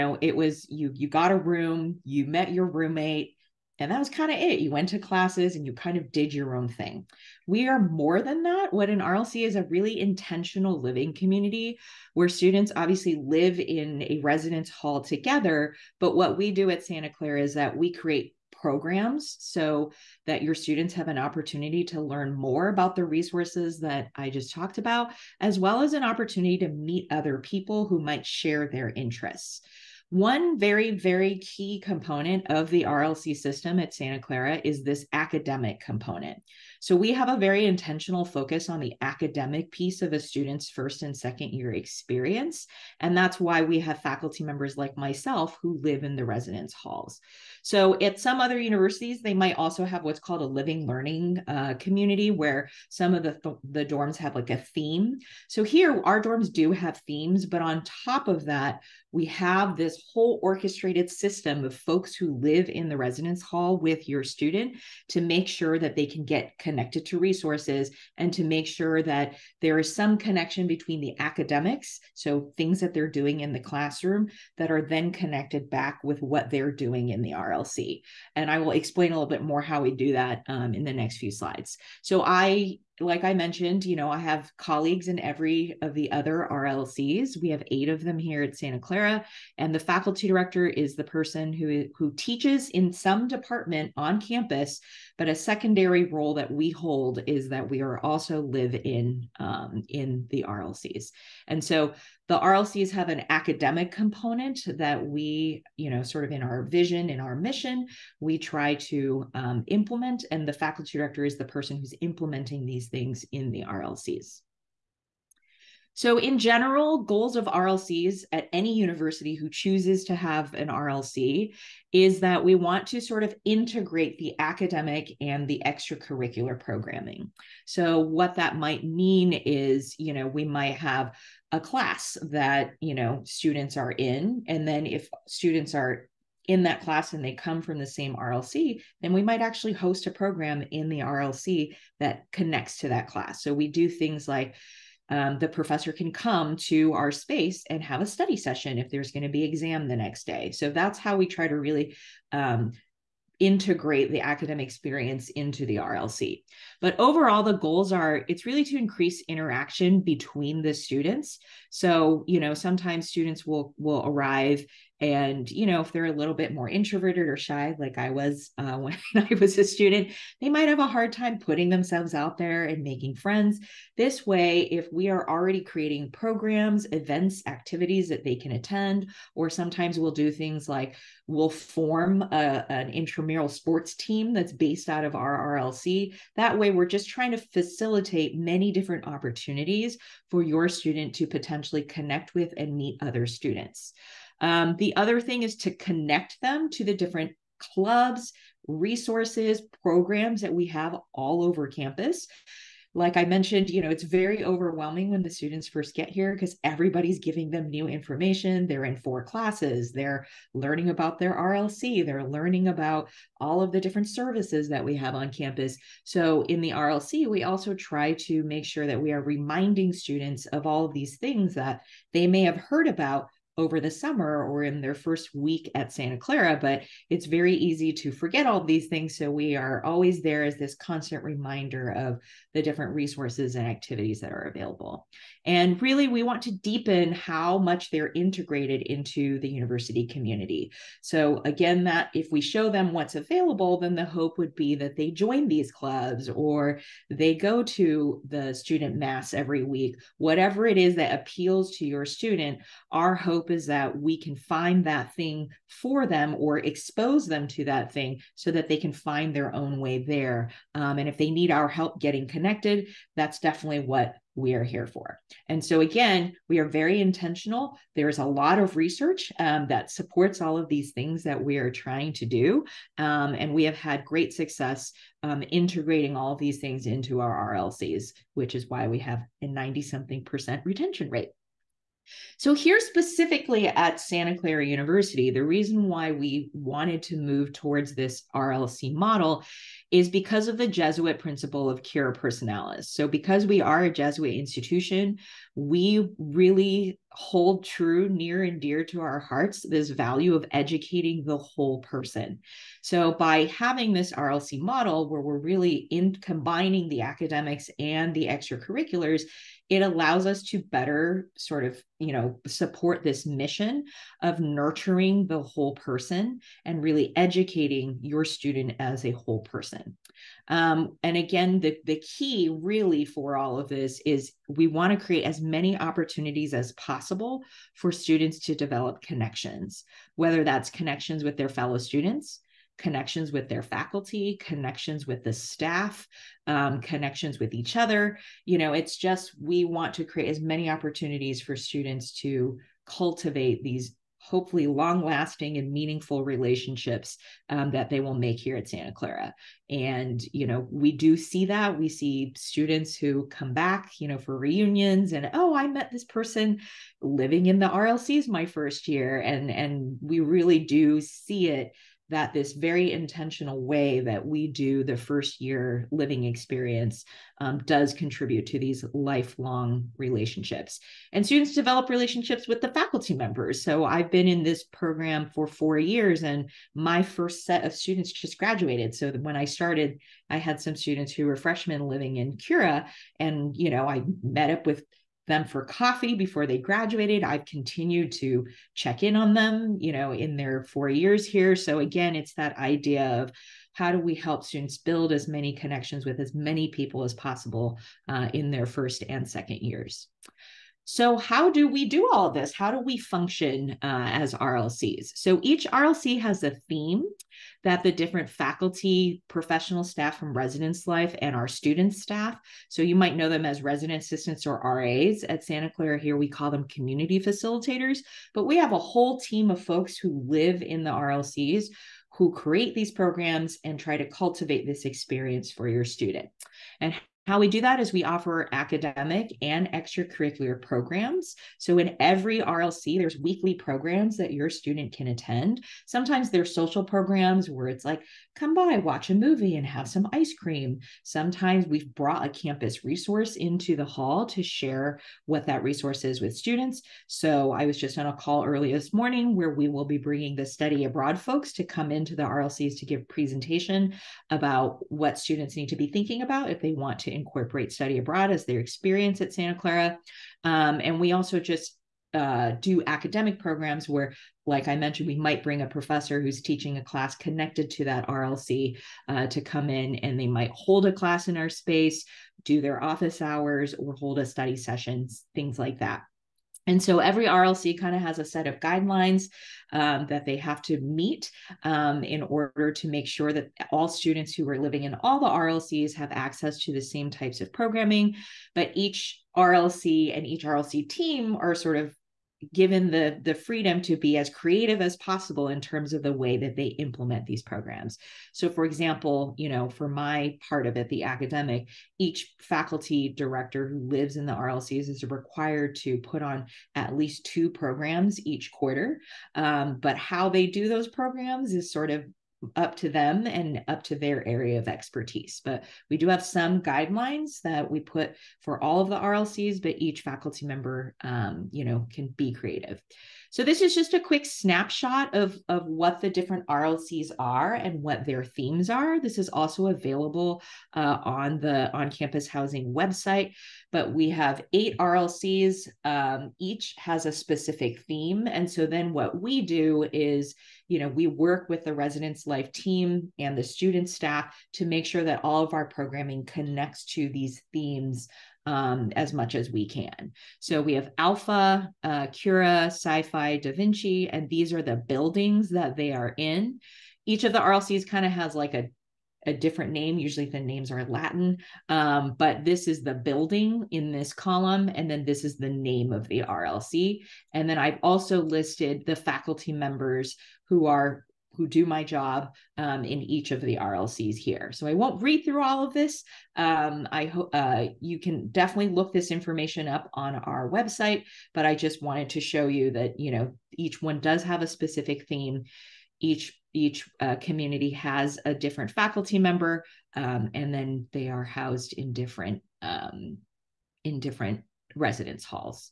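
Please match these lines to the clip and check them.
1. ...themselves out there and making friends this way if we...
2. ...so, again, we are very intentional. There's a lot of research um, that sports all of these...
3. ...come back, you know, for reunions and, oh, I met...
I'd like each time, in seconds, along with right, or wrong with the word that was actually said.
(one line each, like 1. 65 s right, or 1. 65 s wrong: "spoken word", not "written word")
1. 171 s right
2. 265 s wrong: "supports", not "sports"
3. 353 s right.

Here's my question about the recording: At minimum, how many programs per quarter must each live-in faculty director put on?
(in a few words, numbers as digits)
2.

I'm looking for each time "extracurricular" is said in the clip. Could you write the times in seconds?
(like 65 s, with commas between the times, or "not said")
125 s, 308 s, 429 s.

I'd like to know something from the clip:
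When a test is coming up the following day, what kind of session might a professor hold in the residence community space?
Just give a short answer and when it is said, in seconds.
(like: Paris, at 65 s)
study session, at 148 s.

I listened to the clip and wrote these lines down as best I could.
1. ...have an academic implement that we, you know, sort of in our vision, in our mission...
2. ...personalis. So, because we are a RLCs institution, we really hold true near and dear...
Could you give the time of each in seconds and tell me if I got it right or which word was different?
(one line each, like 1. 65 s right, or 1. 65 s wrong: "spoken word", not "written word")
1. 102 s wrong: "component", not "implement"
2. 292 s wrong: "Jesuit", not "RLCs".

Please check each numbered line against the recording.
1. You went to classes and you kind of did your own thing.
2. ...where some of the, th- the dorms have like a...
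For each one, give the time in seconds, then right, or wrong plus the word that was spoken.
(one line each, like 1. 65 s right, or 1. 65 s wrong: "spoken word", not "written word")
1. 4 s right
2. 52 s right.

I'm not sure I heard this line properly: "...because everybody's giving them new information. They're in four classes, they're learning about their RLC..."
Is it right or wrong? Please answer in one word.
right.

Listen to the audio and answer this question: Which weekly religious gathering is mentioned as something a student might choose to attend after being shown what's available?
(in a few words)
student mass.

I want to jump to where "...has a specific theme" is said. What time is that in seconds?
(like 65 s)
536 s.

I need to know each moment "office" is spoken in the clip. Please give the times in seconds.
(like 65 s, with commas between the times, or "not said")
472 s.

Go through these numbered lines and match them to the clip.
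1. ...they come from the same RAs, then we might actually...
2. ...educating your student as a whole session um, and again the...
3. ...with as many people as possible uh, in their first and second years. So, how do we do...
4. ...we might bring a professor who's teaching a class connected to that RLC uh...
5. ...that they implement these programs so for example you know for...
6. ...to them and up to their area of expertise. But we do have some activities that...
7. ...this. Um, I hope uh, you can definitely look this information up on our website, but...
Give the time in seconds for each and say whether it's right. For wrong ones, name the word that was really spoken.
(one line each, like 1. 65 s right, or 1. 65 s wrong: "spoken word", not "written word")
1. 137 s wrong: "RLC", not "RAs"
2. 317 s wrong: "person", not "session"
3. 396 s right
4. 465 s right
5. 496 s right
6. 512 s wrong: "guidelines", not "activities"
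7. 575 s right.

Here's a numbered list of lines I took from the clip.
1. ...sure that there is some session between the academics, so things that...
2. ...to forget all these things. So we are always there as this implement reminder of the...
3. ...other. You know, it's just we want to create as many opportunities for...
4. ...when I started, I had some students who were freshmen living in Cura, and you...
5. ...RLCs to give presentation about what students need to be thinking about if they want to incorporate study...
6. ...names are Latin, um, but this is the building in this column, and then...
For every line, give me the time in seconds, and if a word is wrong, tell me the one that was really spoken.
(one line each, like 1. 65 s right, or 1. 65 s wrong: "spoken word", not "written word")
1. 68 s wrong: "connection", not "session"
2. 227 s wrong: "constant", not "implement"
3. 337 s right
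4. 379 s right
5. 452 s right
6. 560 s right.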